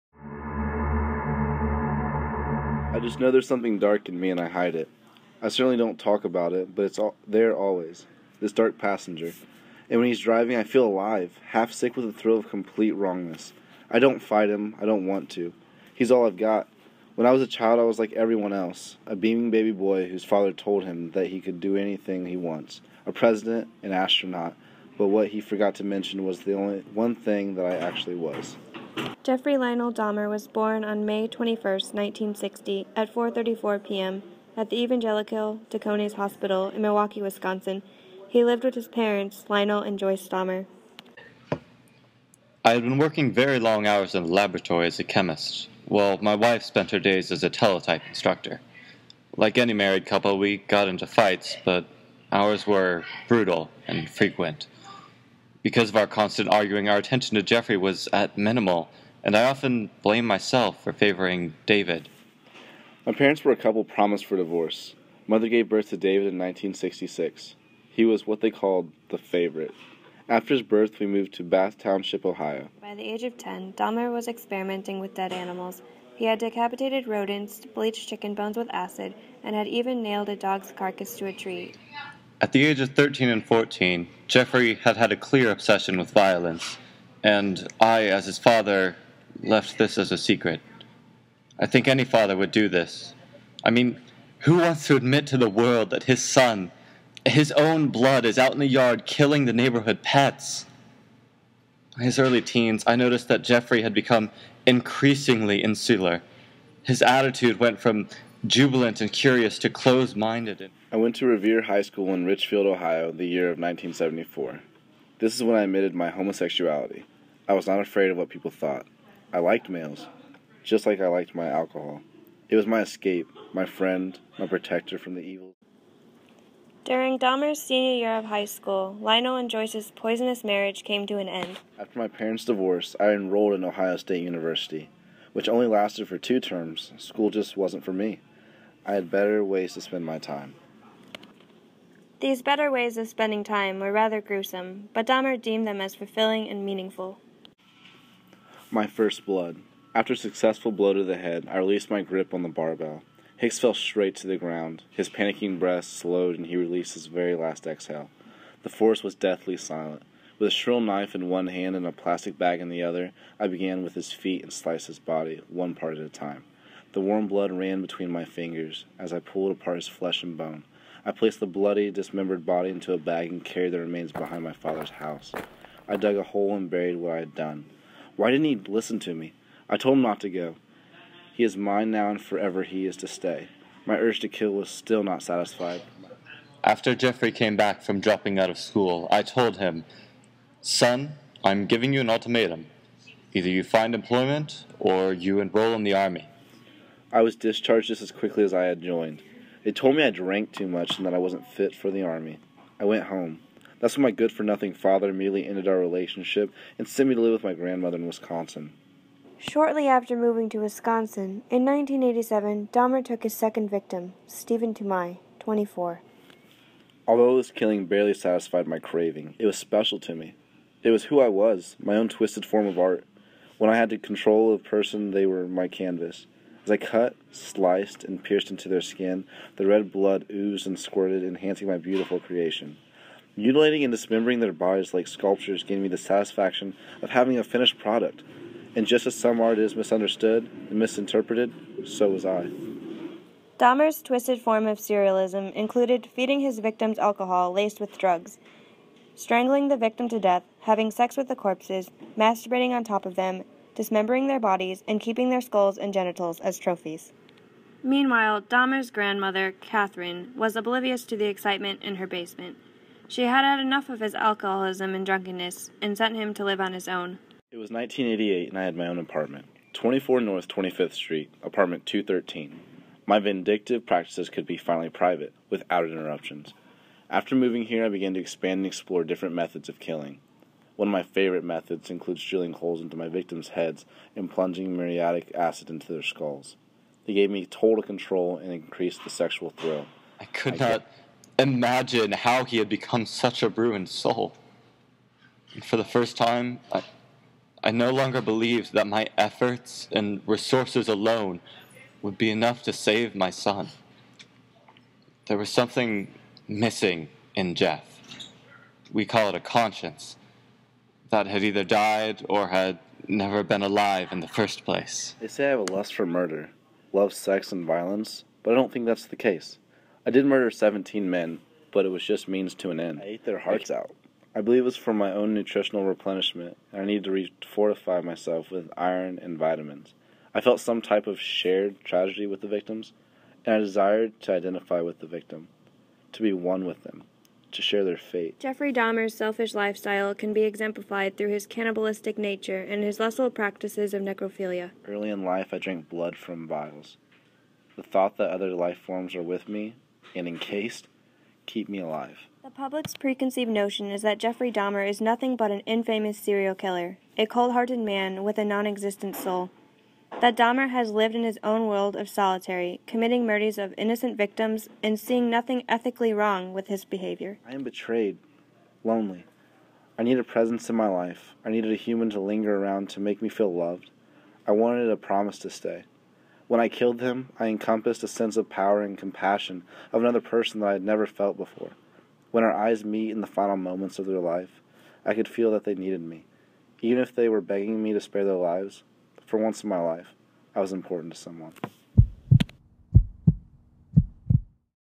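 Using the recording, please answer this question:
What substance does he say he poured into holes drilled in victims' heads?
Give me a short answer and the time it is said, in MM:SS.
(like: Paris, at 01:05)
muriatic acid, at 04:44.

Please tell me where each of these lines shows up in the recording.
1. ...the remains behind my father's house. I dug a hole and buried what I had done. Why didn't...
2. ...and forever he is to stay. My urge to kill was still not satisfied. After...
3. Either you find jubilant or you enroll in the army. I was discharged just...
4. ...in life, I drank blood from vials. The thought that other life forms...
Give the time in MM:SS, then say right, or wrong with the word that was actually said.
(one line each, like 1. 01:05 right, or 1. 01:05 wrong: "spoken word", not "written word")
1. 02:53 right
2. 03:02 right
3. 03:13 wrong: "employment", not "jubilant"
4. 05:45 right.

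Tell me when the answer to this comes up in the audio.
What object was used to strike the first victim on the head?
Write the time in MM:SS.
02:32.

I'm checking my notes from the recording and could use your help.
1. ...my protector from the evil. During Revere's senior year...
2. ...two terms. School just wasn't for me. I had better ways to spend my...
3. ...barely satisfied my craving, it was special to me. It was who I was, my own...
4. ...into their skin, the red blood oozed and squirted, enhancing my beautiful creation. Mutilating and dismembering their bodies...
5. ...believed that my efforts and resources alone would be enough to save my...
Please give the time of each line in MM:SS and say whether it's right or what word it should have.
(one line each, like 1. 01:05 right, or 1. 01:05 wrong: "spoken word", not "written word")
1. 02:04 wrong: "Dahmer", not "Revere"
2. 02:16 right
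3. 03:37 right
4. 03:48 right
5. 04:58 right.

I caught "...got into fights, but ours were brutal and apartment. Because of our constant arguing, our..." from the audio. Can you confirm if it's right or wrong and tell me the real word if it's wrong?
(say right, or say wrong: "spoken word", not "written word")
wrong: "frequent", not "apartment".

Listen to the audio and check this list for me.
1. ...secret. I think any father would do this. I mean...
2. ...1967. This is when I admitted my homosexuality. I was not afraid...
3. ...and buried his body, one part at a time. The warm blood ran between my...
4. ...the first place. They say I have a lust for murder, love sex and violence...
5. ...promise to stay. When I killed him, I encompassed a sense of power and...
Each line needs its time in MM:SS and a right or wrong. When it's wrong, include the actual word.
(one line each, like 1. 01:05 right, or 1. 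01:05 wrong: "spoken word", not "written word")
1. 01:30 right
2. 01:53 wrong: "1974", not "1967"
3. 02:44 wrong: "sliced", not "buried"
4. 05:14 right
5. 06:14 right.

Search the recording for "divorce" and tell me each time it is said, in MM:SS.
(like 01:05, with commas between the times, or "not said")
01:04, 02:12.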